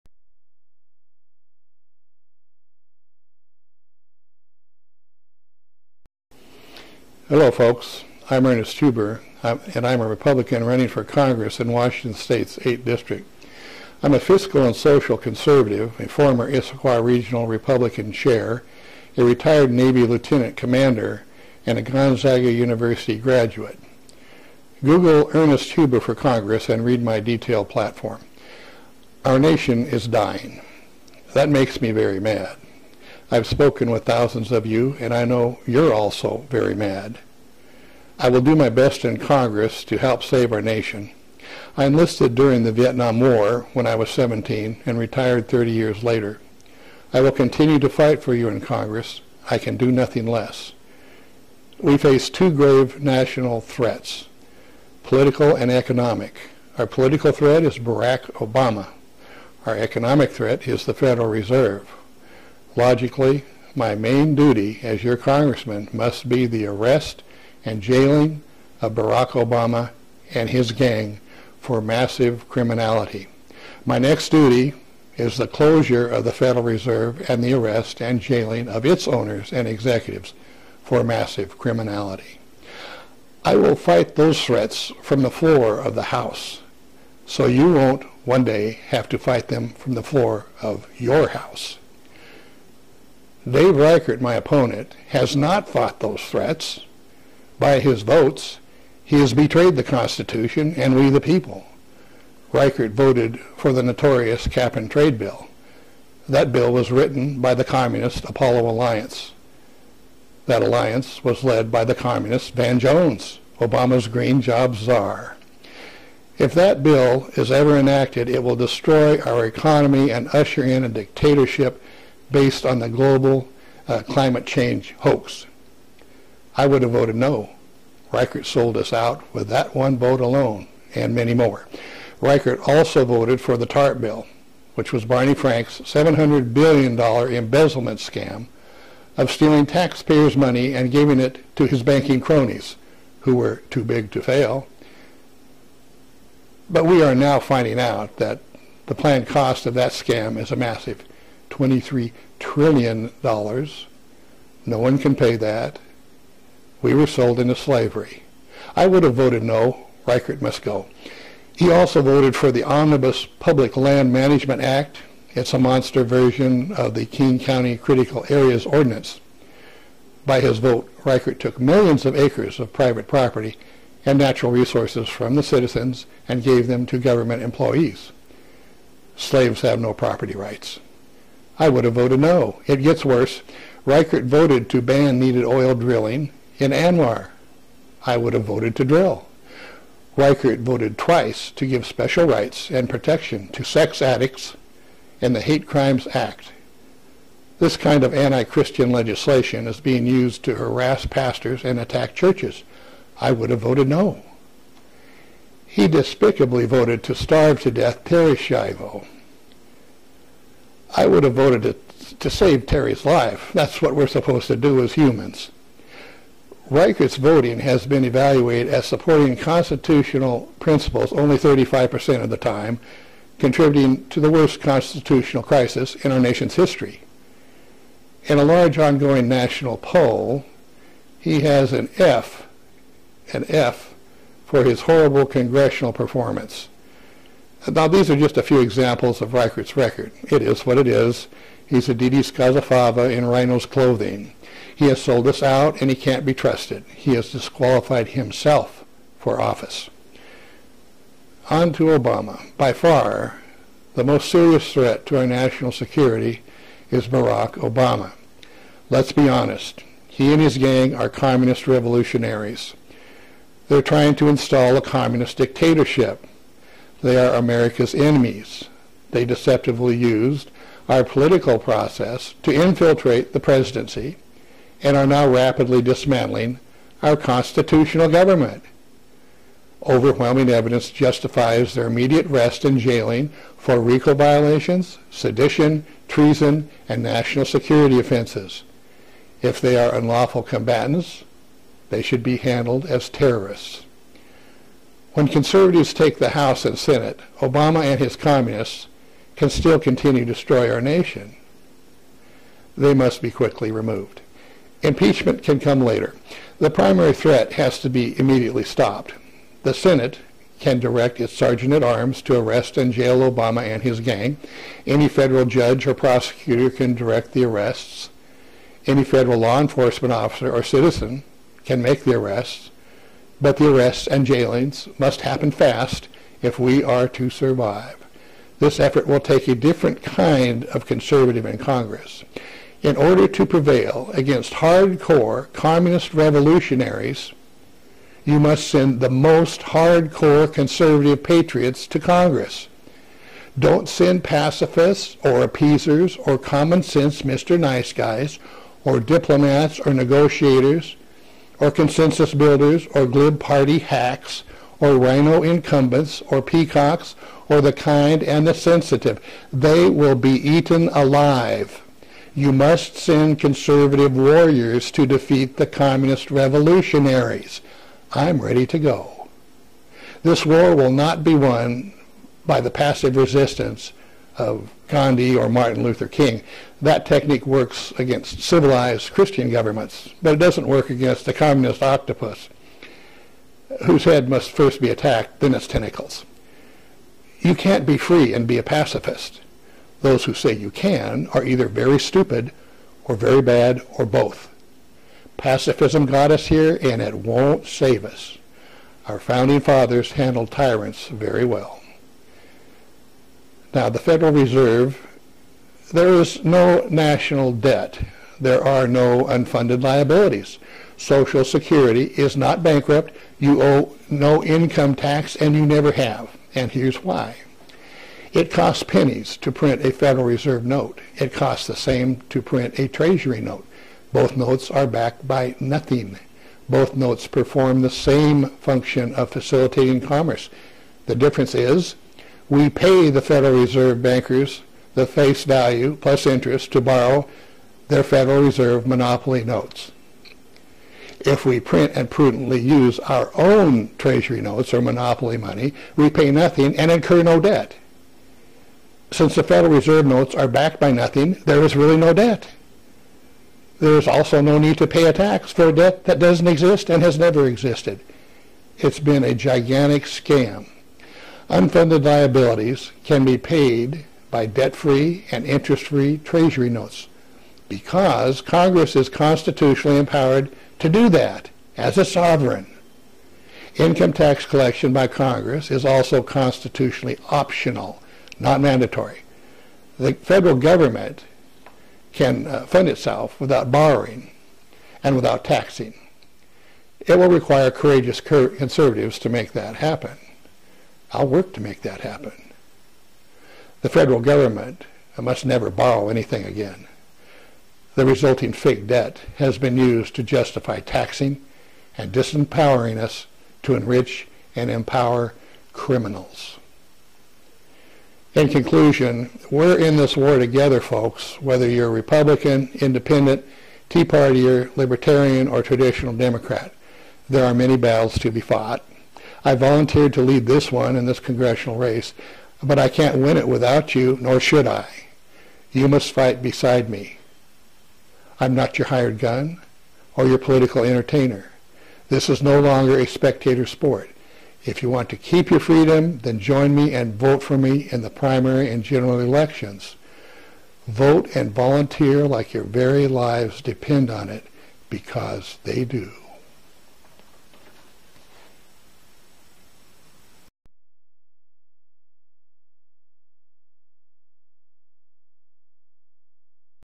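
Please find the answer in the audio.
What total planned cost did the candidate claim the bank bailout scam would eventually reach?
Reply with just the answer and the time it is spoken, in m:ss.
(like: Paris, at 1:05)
$23 trillion, at 2:31.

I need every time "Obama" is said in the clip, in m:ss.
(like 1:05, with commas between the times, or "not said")
0:58, 1:09, 1:53, 4:11, 4:17, 4:57, 5:13.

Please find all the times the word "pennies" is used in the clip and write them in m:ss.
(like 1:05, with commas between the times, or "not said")
6:58.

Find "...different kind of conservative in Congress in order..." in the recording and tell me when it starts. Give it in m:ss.
5:29.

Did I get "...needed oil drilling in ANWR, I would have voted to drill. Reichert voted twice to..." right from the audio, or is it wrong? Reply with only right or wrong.
right.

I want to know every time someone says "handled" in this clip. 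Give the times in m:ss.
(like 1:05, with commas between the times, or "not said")
4:52, 6:40.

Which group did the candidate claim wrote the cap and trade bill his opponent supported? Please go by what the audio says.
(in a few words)
Apollo Alliance.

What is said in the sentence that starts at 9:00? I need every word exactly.
Vote and volunteer like your very lives depend on it, because they do.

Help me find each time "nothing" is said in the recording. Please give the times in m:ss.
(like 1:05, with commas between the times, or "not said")
0:49, 7:05, 7:26, 7:30.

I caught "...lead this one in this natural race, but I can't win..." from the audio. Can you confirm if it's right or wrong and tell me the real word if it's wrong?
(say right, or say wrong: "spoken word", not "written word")
wrong: "congressional", not "natural".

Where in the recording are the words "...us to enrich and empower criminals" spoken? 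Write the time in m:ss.
8:22.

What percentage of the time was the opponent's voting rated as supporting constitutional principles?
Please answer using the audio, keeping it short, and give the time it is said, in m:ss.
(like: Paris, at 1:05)
35%, at 3:41.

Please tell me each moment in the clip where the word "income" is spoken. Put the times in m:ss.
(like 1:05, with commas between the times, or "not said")
6:54, 7:53.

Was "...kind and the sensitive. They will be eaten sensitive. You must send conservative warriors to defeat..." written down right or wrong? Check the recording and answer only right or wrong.
wrong.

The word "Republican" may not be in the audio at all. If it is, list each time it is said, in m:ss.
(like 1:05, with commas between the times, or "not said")
0:10, 0:17, 8:31.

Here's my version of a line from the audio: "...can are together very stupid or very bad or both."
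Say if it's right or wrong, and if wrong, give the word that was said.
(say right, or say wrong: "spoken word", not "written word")
wrong: "either", not "together".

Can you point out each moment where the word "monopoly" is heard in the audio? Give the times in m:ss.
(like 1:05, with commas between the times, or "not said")
7:18, 7:24.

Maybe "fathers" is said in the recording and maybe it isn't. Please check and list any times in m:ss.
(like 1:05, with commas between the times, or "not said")
6:39.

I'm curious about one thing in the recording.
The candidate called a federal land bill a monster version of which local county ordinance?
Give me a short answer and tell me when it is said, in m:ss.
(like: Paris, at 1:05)
King County Critical Areas Ordinance, at 2:47.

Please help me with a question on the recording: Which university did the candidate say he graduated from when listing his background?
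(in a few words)
Gonzaga University.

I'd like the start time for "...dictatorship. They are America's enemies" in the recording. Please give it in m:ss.
4:25.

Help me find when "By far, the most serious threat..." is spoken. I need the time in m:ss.
4:12.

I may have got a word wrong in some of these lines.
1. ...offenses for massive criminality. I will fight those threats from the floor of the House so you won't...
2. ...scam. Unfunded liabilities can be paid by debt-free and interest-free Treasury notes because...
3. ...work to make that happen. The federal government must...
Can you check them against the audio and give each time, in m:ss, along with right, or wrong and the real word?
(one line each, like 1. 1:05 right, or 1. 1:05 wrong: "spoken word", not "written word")
1. 1:19 wrong: "executives", not "offenses"
2. 7:40 right
3. 8:11 right.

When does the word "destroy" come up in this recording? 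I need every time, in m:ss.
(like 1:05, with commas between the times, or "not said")
1:58, 5:00.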